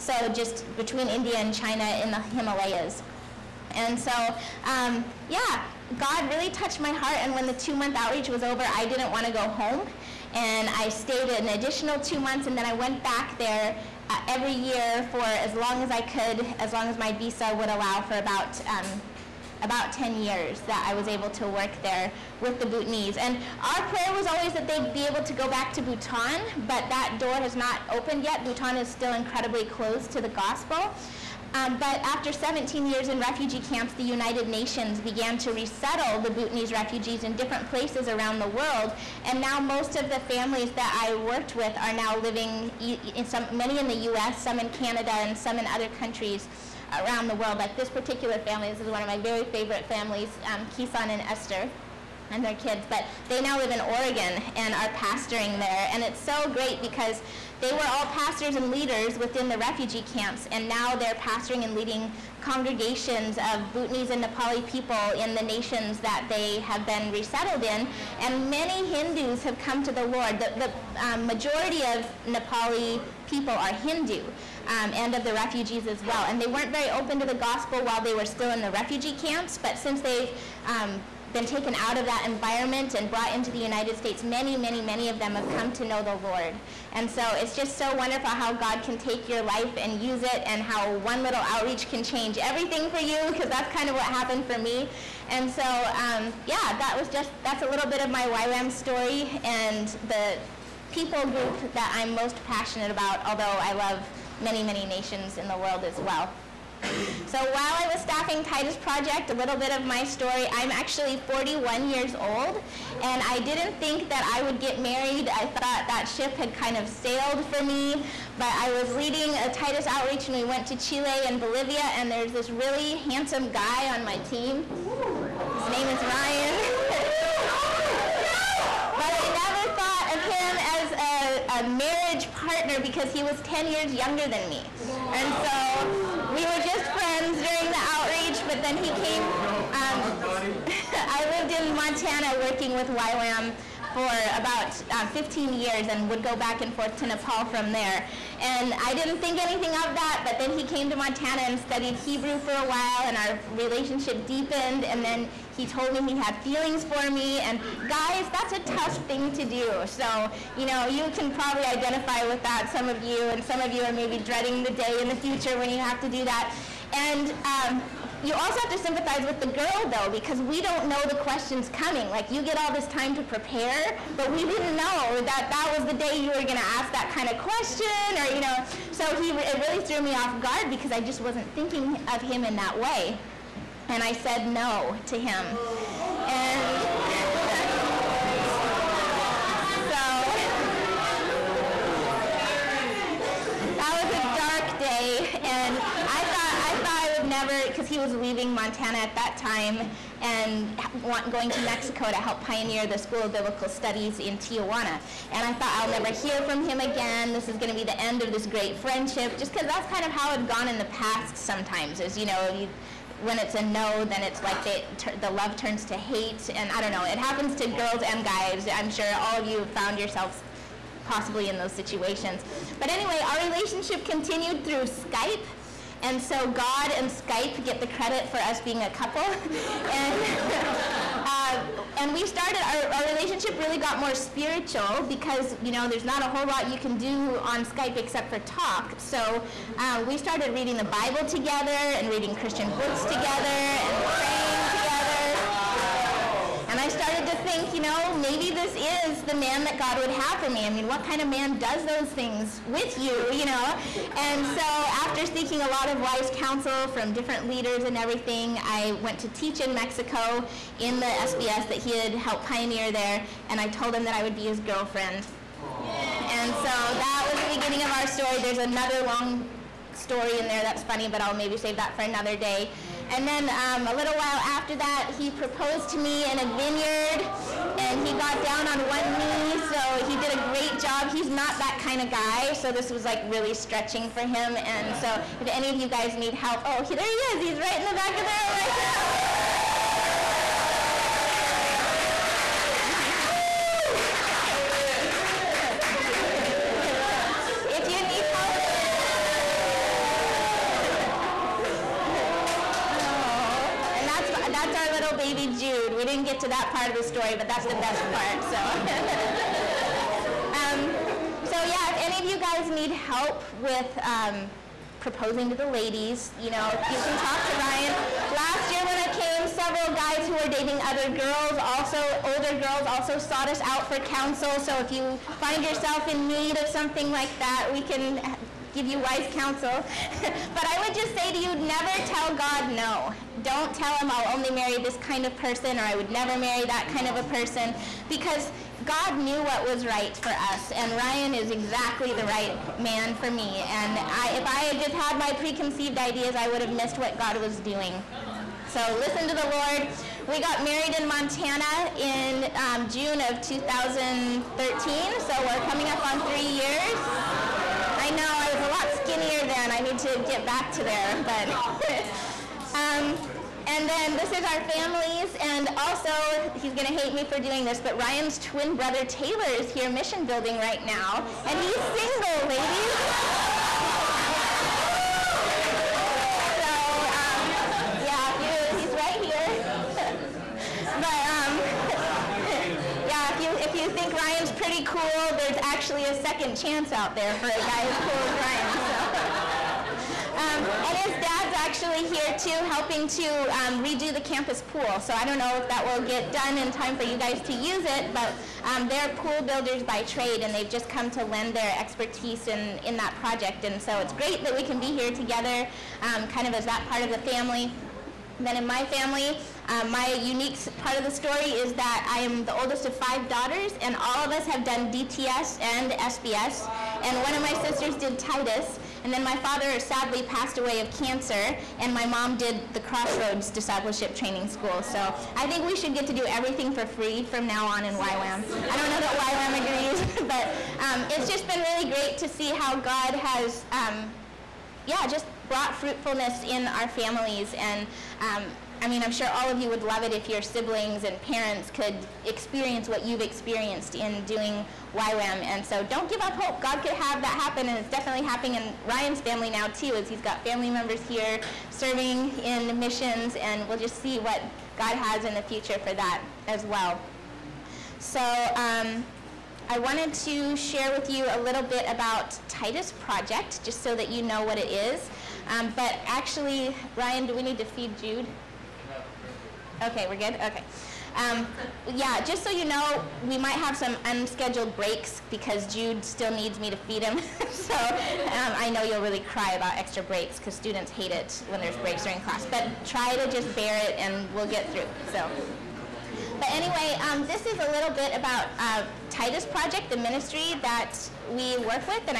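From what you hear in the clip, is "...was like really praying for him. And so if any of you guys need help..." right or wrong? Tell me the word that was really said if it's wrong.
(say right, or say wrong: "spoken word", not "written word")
wrong: "stretching", not "praying".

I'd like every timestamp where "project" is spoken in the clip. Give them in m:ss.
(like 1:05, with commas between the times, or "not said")
1:48, 6:43, 7:42, 8:09.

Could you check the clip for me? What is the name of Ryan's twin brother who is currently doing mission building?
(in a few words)
Taylor.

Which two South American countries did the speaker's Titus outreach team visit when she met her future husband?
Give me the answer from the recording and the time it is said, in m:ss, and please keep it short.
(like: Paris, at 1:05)
Chile and Bolivia, at 2:00.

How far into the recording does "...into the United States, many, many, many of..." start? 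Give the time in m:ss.
1:23.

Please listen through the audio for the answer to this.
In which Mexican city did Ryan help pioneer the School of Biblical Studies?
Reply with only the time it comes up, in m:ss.
3:24.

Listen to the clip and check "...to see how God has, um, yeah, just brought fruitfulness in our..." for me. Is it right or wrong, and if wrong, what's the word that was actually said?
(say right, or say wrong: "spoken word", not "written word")
right.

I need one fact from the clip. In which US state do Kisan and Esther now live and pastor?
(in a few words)
Oregon.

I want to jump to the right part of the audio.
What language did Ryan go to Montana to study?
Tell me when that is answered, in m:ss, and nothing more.
2:31.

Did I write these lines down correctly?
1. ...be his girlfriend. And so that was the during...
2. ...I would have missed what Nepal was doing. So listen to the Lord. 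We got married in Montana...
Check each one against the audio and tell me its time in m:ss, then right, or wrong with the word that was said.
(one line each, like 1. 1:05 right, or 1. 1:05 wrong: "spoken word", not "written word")
1. 4:24 wrong: "beginning", not "during"
2. 5:46 wrong: "God", not "Nepal".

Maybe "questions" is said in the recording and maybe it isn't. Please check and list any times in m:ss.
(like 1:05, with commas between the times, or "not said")
2:51, 2:57.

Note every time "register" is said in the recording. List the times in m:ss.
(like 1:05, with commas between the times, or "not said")
not said.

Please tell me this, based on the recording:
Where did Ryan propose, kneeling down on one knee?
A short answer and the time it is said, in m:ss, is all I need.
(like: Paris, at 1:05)
In a vineyard, at 4:36.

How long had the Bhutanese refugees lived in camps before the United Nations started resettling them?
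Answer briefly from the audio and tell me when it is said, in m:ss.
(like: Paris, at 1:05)
17 years, at 0:32.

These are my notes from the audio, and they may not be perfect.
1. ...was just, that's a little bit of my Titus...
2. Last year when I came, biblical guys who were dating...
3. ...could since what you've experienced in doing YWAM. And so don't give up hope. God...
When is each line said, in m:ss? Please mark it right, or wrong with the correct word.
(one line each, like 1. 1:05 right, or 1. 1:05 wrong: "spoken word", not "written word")
1. 1:36 wrong: "YWAM", not "Titus"
2. 5:18 wrong: "several", not "biblical"
3. 7:21 wrong: "experience", not "since".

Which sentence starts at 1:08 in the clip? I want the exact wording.
And many Hindus have come to the Lord.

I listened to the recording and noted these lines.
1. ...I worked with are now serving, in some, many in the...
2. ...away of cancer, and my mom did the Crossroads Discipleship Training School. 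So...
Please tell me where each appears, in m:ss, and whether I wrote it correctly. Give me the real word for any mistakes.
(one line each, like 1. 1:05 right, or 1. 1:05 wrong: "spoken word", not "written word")
1. 0:40 wrong: "living", not "serving"
2. 7:00 right.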